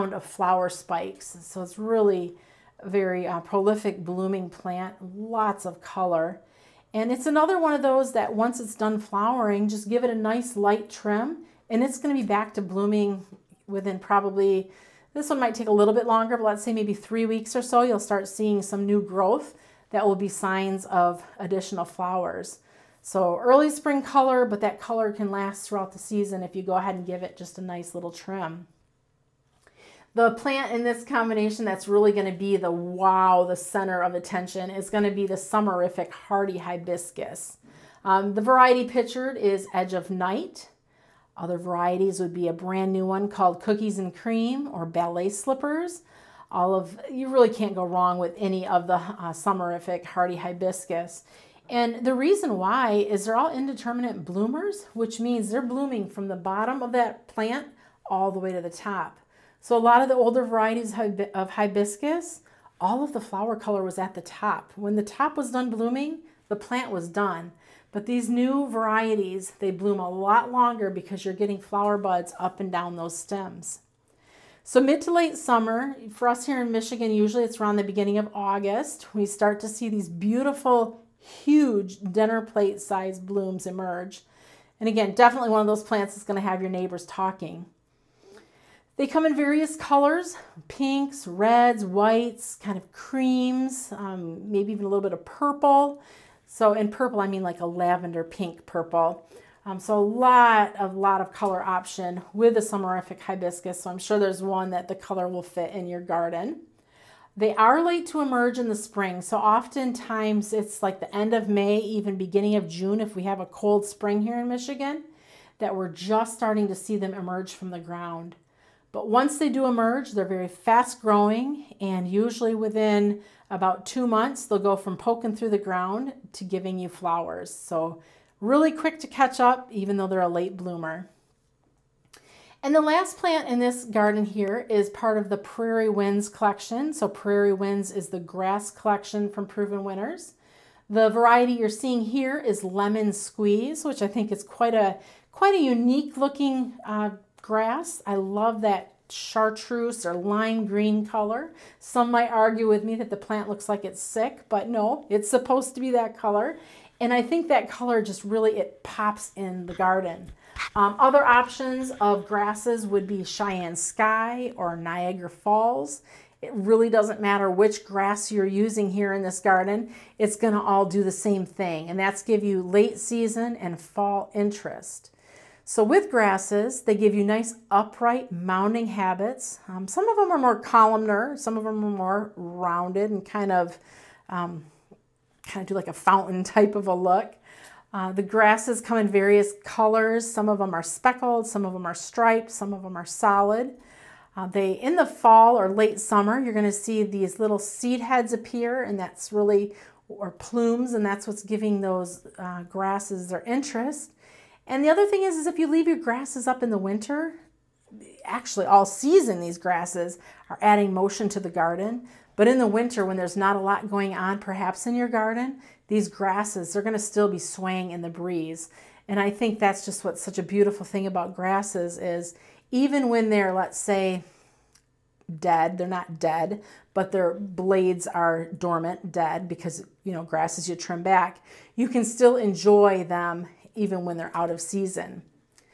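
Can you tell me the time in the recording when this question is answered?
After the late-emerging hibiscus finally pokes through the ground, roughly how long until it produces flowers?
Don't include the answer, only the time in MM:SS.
02:03.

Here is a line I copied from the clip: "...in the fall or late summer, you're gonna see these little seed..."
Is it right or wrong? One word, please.
right.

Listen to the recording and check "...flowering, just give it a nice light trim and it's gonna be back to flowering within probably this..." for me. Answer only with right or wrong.
wrong.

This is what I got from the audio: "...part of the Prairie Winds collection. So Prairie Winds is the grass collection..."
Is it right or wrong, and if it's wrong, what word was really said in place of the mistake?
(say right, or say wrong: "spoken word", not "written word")
right.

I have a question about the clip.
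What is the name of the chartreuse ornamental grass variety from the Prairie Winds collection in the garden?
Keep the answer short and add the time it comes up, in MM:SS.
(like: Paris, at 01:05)
Lemon Squeeze, at 02:22.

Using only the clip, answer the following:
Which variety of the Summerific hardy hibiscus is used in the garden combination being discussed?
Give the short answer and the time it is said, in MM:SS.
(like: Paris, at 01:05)
Edge of Night, at 00:39.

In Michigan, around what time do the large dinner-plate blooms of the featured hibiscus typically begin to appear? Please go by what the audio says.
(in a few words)
Beginning of August.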